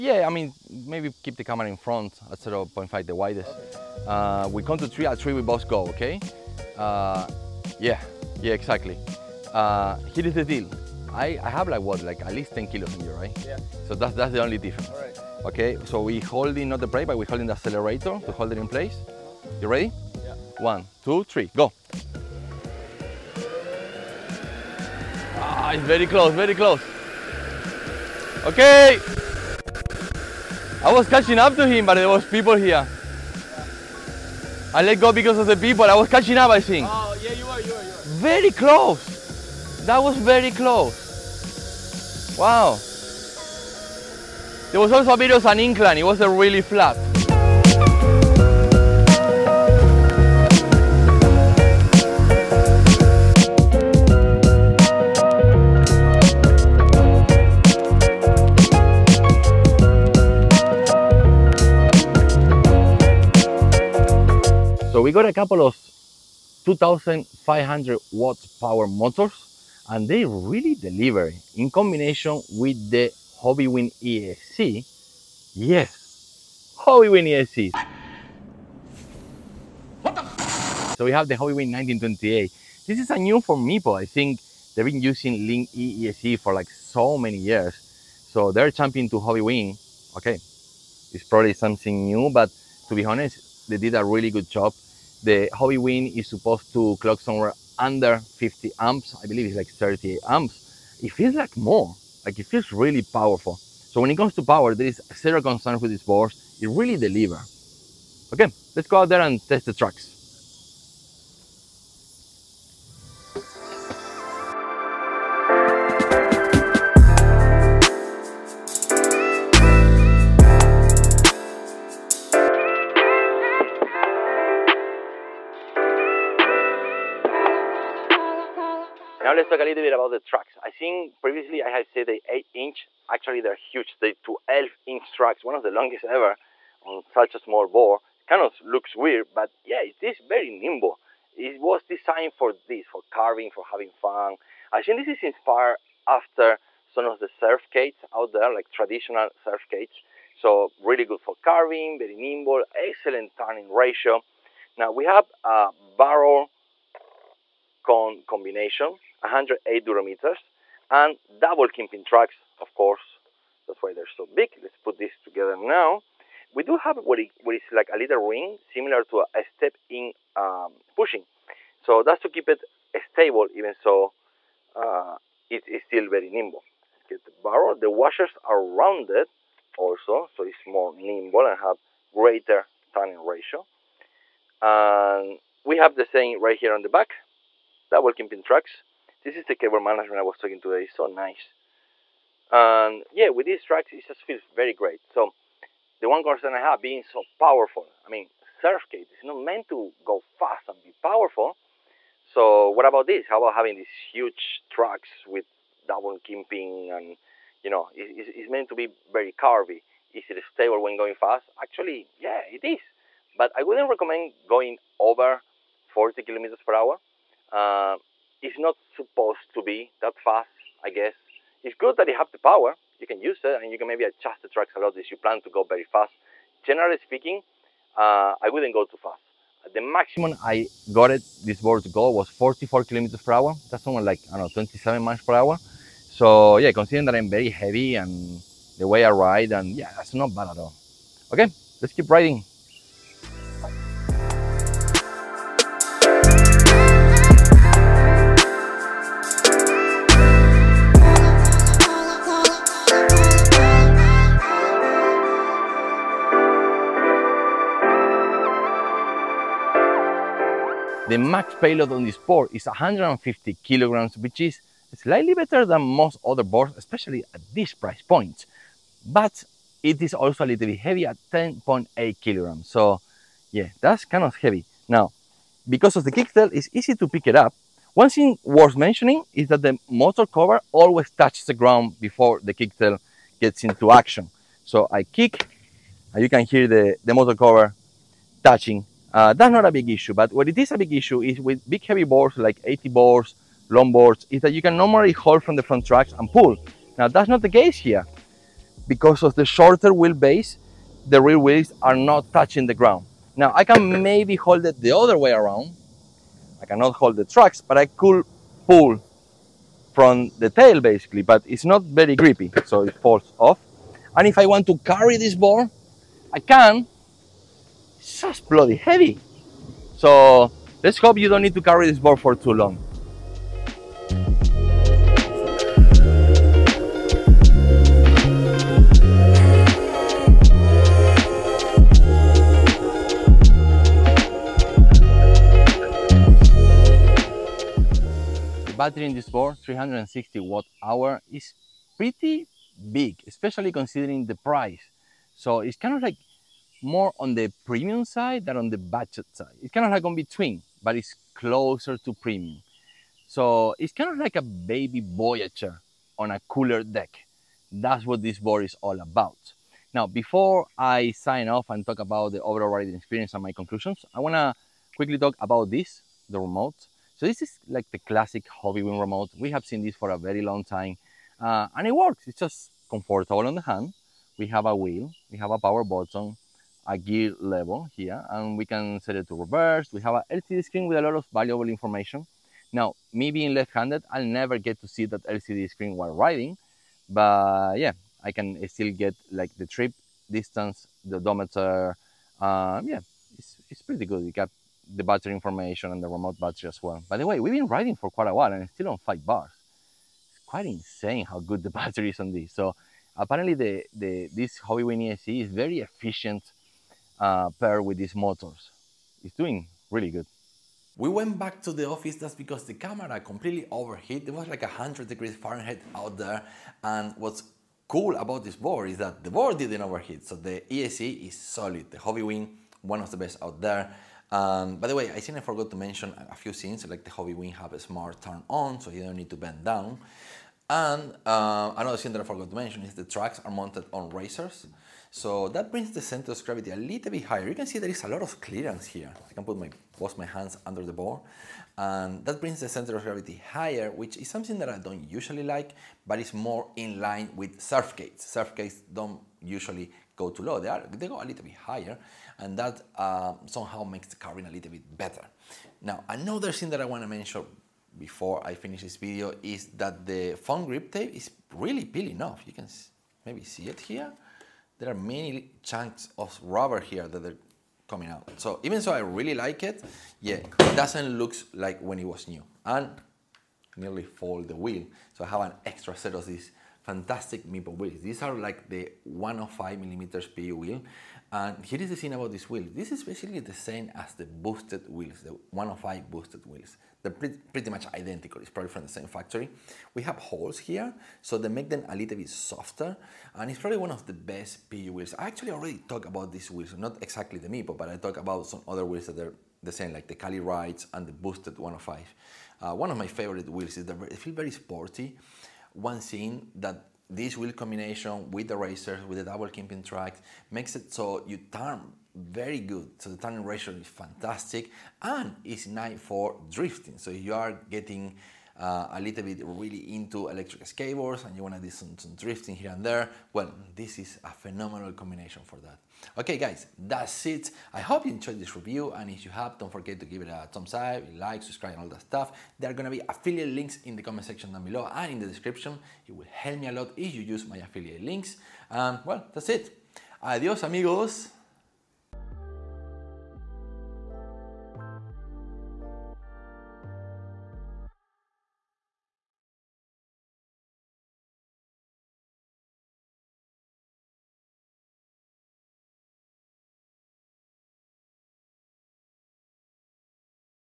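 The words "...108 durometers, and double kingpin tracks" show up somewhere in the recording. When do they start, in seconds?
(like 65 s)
159 s.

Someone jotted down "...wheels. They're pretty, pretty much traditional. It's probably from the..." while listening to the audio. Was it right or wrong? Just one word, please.
wrong.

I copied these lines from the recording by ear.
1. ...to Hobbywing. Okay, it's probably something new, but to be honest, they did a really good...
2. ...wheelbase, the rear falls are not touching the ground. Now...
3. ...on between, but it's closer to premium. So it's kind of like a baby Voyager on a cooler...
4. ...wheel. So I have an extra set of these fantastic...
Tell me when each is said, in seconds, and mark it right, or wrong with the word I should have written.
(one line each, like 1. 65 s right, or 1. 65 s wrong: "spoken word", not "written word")
1. 89 s right
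2. 299 s wrong: "wheels", not "falls"
3. 350 s right
4. 474 s right.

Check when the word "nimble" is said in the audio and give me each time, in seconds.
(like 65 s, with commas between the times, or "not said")
140 s, 152 s, 176 s, 180 s.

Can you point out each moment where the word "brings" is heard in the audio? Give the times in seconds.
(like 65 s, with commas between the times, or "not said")
435 s, 442 s.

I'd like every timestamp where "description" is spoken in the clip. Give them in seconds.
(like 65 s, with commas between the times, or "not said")
535 s.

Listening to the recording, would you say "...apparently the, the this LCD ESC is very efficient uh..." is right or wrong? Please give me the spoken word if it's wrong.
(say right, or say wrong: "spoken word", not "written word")
wrong: "Hobbywing", not "LCD".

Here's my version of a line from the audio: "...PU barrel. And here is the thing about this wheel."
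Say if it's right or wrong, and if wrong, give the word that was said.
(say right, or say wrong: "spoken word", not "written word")
wrong: "wheel", not "barrel".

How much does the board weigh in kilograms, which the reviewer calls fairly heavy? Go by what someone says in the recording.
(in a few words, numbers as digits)
10.8 kilograms.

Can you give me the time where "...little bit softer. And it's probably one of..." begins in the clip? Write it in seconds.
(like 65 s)
491 s.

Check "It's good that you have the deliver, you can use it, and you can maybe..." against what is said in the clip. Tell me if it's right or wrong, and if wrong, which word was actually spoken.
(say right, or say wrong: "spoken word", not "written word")
wrong: "power", not "deliver".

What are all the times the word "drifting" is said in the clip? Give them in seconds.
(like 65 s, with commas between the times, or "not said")
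516 s, 522 s.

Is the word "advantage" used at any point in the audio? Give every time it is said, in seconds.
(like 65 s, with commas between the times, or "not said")
not said.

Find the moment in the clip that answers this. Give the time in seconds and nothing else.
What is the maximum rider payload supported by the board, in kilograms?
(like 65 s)
262 s.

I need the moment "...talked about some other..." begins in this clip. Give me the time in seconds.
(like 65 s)
497 s.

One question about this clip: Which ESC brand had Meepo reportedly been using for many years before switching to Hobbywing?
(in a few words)
Link E.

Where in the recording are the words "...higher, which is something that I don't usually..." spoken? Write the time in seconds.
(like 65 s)
443 s.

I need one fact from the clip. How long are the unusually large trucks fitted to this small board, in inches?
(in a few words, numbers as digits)
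12 inch.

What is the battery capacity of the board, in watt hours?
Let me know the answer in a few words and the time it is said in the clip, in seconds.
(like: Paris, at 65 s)
360, at 339 s.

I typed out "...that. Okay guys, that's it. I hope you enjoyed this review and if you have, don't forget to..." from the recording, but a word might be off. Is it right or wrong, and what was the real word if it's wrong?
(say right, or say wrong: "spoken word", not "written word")
right.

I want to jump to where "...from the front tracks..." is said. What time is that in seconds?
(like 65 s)
295 s.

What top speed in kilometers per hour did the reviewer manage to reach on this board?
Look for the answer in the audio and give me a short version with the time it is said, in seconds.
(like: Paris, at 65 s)
44, at 232 s.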